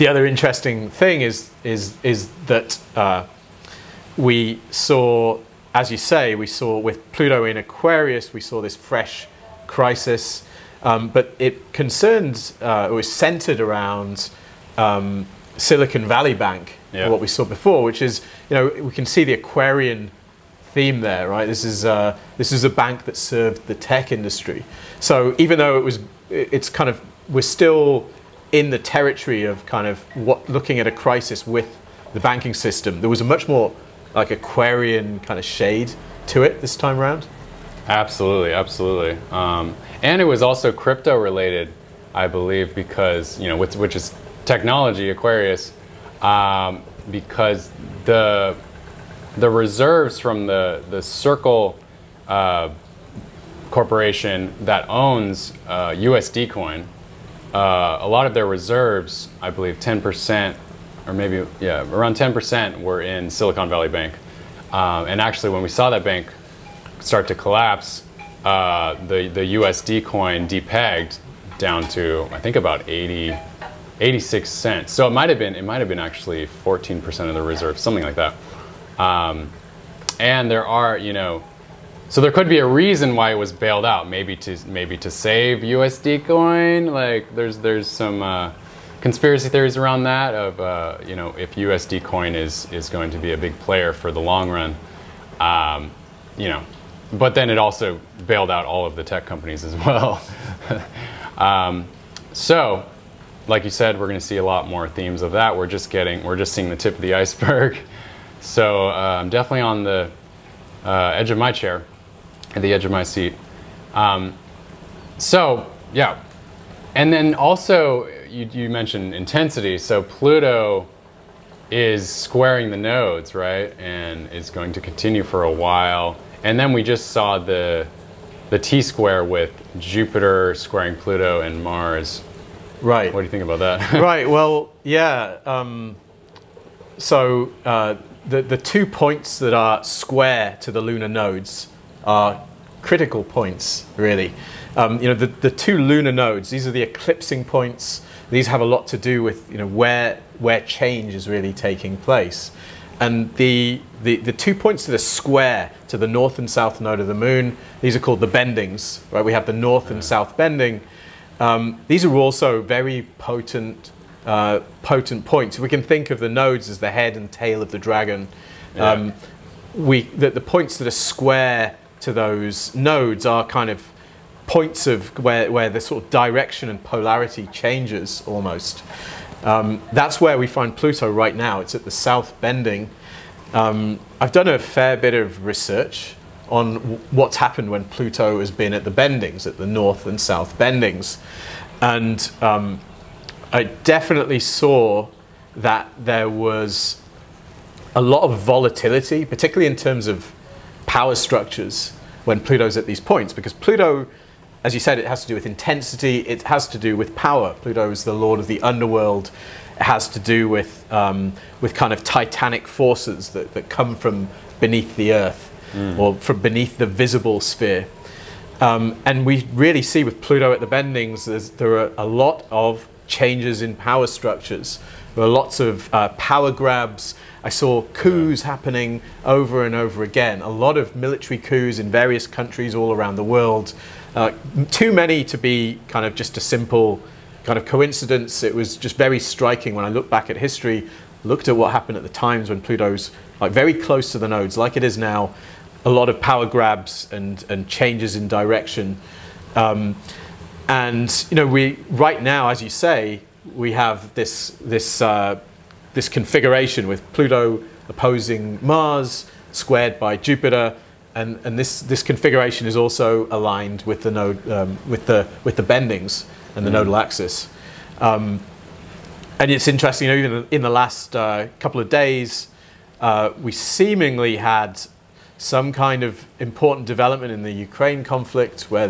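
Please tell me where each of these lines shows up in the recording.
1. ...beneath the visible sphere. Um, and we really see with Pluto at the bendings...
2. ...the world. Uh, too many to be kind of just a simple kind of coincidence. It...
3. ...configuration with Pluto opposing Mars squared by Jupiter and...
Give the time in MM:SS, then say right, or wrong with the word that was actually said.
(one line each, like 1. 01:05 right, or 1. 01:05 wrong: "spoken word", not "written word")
1. 03:36 right
2. 03:53 right
3. 04:16 right.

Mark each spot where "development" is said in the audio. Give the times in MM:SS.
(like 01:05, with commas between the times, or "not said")
04:36.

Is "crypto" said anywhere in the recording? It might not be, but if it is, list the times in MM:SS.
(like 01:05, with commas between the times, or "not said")
00:40.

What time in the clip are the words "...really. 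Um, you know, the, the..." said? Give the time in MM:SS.
02:23.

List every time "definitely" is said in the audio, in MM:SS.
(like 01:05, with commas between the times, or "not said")
01:49, 03:13.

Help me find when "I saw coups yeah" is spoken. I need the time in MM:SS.
03:47.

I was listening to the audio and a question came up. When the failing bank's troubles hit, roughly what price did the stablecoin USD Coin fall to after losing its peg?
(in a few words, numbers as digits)
86 cents.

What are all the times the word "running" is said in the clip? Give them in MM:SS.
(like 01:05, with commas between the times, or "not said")
not said.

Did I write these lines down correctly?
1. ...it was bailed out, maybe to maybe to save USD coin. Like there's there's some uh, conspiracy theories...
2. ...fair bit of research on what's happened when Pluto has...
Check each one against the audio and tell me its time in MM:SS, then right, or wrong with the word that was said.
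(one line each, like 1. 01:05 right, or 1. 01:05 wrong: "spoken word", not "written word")
1. 01:23 right
2. 03:04 right.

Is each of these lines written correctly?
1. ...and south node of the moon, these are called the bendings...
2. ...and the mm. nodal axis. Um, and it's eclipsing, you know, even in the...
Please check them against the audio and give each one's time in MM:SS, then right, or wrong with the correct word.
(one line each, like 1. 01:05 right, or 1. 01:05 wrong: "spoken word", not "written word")
1. 02:36 right
2. 04:26 wrong: "interesting", not "eclipsing".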